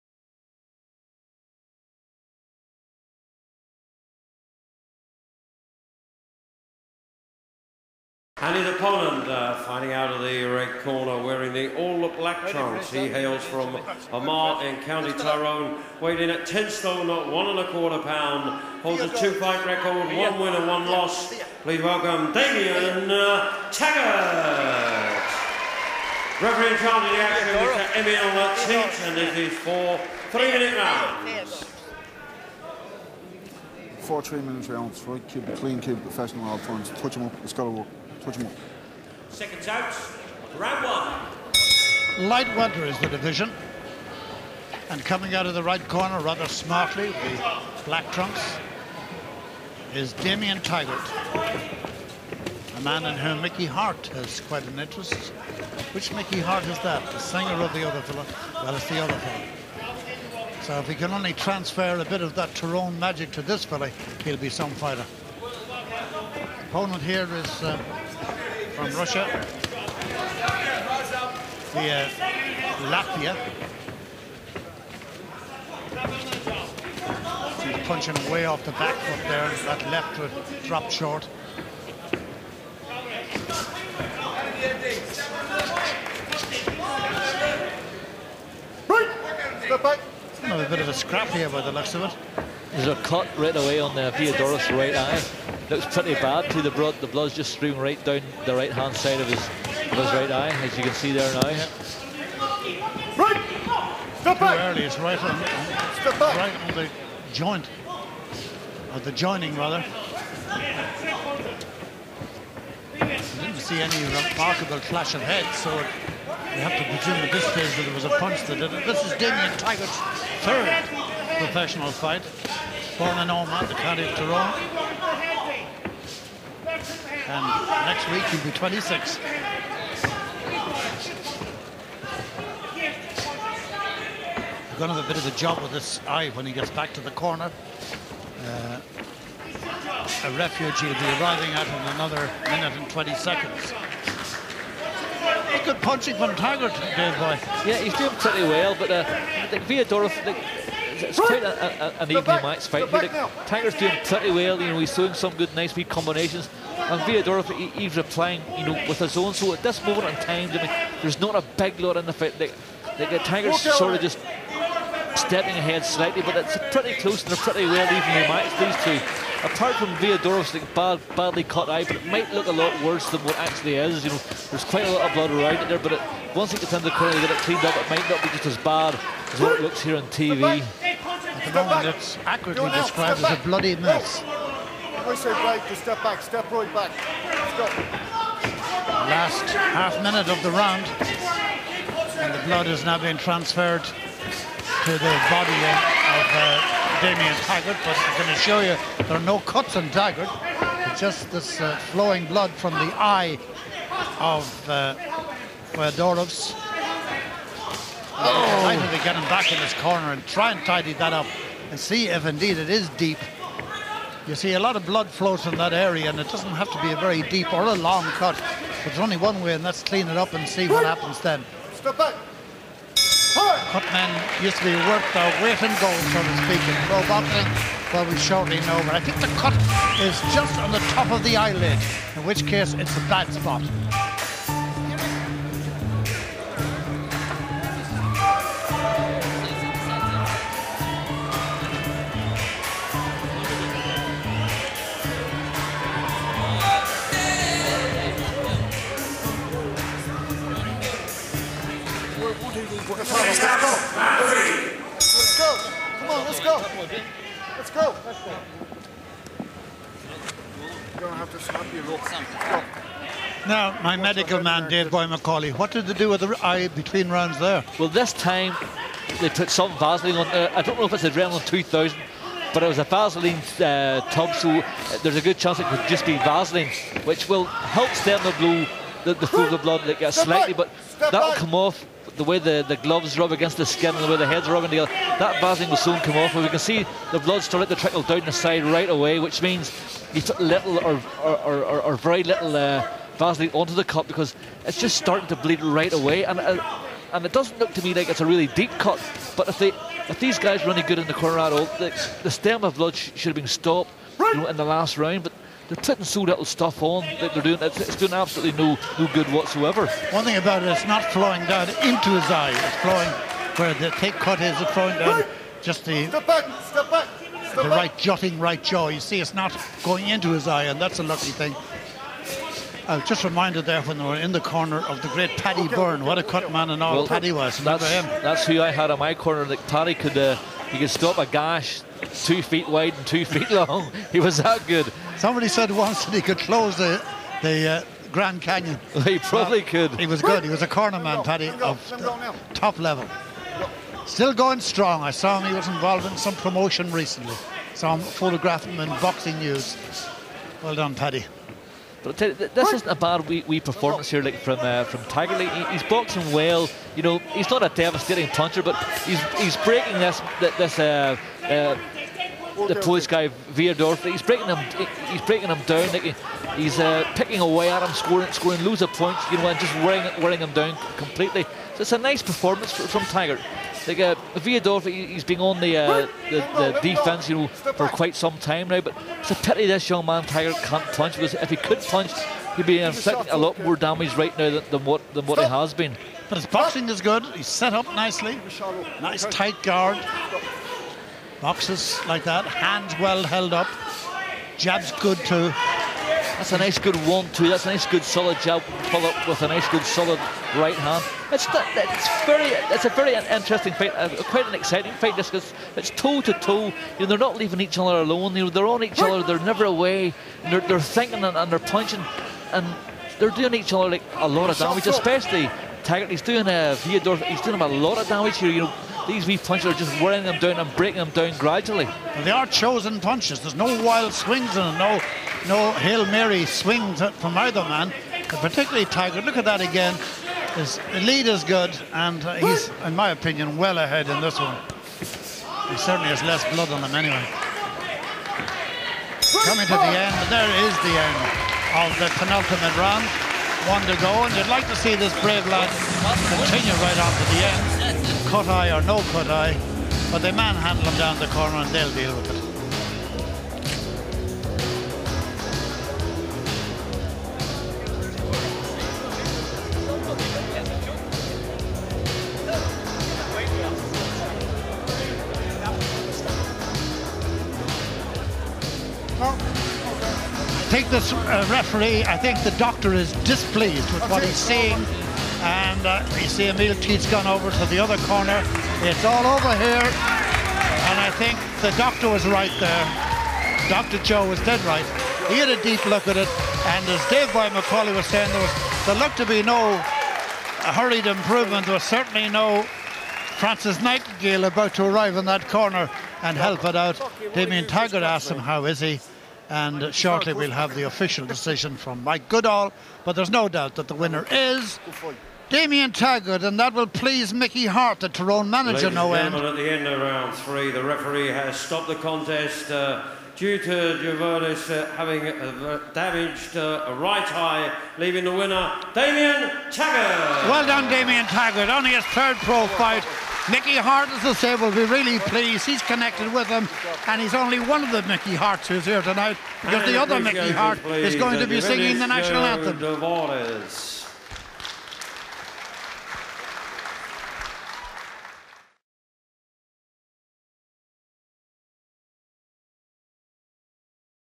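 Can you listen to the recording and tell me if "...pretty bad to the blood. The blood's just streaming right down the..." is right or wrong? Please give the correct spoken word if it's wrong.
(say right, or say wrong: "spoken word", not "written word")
right.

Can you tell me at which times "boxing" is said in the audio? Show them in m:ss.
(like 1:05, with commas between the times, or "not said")
3:47, 5:49, 5:55, 6:26.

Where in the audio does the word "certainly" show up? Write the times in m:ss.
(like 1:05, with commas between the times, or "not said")
7:15, 8:11.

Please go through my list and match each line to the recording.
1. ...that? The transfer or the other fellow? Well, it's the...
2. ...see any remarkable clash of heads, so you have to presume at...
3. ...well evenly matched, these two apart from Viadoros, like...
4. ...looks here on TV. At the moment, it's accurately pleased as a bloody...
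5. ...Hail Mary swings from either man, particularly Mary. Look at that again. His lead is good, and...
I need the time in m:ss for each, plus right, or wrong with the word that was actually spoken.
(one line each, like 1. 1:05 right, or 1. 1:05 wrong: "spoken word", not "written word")
1. 0:56 wrong: "singer", not "transfer"
2. 1:53 right
3. 2:47 right
4. 2:59 wrong: "described", not "pleased"
5. 7:05 wrong: "Tiger", not "Mary".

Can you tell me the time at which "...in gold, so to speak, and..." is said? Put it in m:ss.
3:45.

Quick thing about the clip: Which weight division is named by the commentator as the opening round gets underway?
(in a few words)
Light welter.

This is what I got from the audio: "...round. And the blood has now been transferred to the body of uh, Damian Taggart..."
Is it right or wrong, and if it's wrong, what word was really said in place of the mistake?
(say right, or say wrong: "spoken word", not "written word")
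right.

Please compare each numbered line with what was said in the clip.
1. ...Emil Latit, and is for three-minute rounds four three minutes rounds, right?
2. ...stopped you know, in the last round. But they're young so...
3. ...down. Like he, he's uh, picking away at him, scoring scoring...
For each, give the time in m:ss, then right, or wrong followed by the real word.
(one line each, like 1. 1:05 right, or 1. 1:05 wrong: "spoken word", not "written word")
1. 0:28 right
2. 5:03 wrong: "putting", not "young"
3. 6:05 right.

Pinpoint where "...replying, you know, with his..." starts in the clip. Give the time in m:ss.
2:37.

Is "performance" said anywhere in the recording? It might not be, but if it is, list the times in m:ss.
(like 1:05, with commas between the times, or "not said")
5:53, 6:12.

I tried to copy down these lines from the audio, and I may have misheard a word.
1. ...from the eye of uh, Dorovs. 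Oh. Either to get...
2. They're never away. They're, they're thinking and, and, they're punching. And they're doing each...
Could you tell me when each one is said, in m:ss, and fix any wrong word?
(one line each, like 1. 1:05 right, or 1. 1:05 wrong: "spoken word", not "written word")
1. 3:22 right
2. 6:49 right.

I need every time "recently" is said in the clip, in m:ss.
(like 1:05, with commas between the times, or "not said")
5:46.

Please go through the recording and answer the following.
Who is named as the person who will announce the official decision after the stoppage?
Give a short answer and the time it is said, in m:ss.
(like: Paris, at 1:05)
Mike Goodall, at 8:22.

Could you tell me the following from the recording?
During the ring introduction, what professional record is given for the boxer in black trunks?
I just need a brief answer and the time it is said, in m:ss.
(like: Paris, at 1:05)
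1 win and 1 loss, at 0:19.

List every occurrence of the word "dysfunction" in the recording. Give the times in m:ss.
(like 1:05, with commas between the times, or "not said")
not said.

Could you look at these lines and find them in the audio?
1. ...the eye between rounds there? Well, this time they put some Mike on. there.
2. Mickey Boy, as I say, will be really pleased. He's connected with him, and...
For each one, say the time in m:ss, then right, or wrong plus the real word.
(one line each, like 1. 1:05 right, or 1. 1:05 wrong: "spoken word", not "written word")
1. 4:26 wrong: "Vaseline", not "Mike"
2. 8:43 wrong: "Harte", not "Boy".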